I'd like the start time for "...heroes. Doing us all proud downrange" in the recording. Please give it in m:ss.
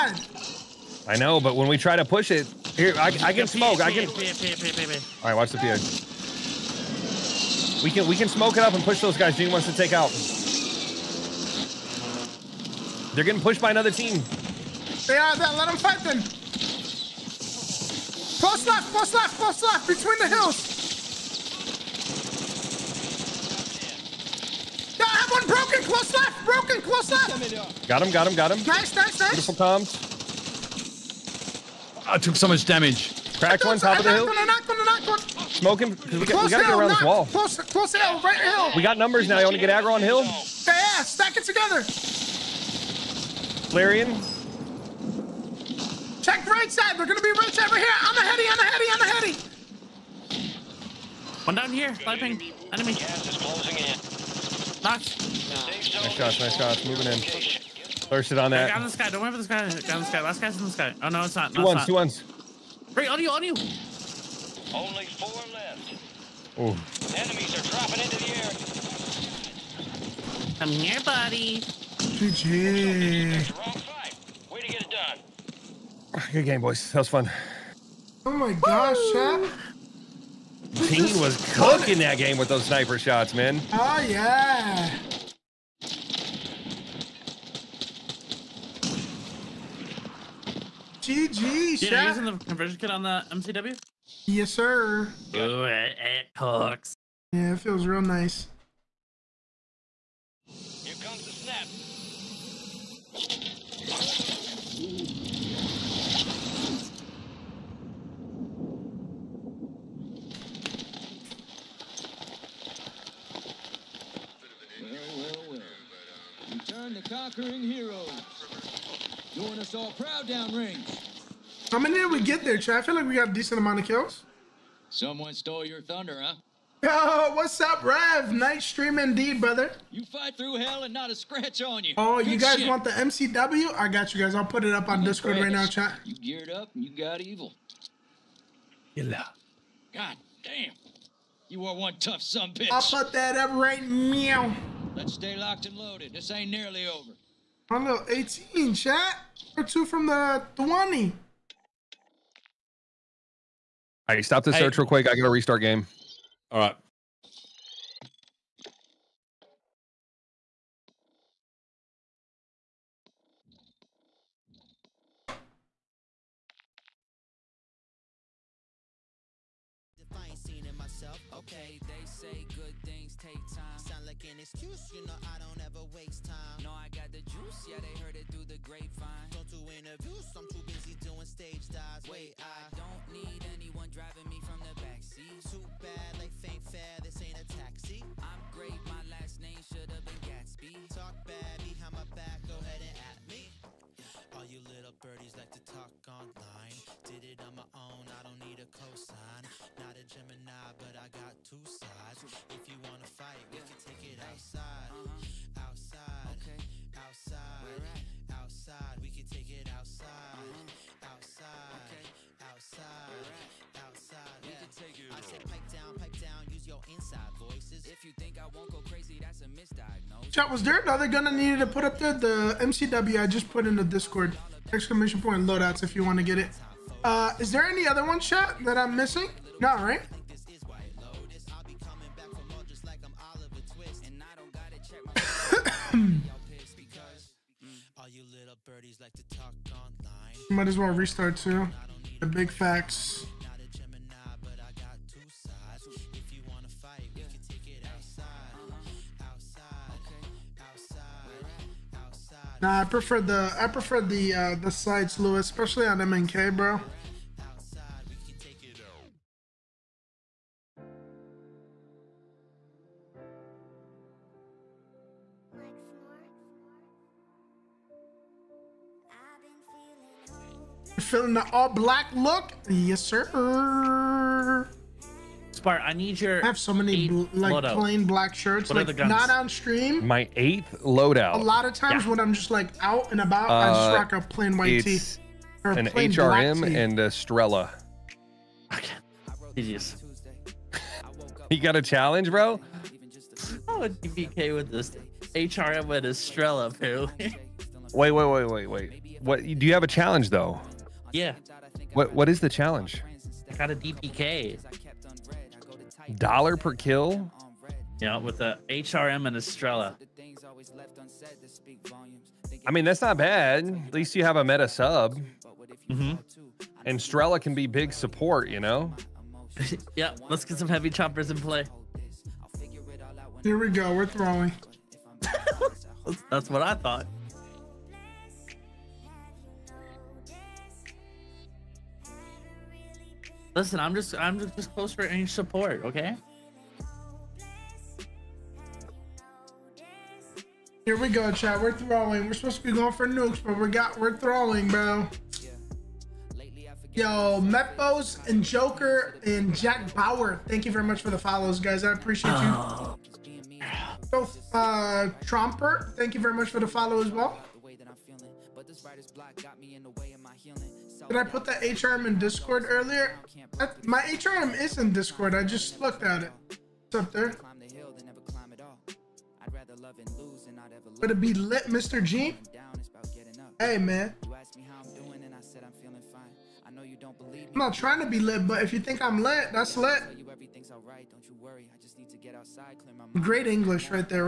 1:57.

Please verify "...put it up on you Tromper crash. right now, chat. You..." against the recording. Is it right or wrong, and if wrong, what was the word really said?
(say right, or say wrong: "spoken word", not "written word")
wrong: "Discord", not "Tromper".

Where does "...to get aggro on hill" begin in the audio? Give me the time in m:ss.
0:39.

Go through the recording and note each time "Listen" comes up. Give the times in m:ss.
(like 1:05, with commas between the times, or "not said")
5:33.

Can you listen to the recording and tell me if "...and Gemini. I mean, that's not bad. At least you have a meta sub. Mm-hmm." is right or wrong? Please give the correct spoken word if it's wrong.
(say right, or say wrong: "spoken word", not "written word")
wrong: "Estrella", not "Gemini".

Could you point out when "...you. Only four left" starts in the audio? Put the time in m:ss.
1:03.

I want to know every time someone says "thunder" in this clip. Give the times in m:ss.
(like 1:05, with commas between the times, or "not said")
2:05.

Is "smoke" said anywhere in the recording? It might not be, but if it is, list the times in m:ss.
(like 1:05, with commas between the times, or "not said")
0:03, 0:08, 0:35.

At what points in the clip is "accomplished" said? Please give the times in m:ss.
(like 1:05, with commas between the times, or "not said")
not said.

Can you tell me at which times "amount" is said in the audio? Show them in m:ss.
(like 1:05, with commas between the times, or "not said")
2:03.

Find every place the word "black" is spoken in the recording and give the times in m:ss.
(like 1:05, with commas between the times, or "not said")
4:31, 4:38.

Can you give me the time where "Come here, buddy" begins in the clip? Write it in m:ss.
1:10.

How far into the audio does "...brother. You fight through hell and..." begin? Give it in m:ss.
2:09.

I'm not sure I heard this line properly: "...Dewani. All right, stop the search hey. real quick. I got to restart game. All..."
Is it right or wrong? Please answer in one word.
right.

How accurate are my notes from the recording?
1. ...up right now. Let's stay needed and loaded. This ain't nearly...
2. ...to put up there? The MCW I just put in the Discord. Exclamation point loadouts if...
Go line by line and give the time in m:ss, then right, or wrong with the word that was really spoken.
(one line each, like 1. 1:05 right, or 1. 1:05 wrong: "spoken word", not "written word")
1. 2:23 wrong: "locked", not "needed"
2. 3:41 right.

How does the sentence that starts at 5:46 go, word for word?
Yo, Mepos and Joker and Jack Bauer.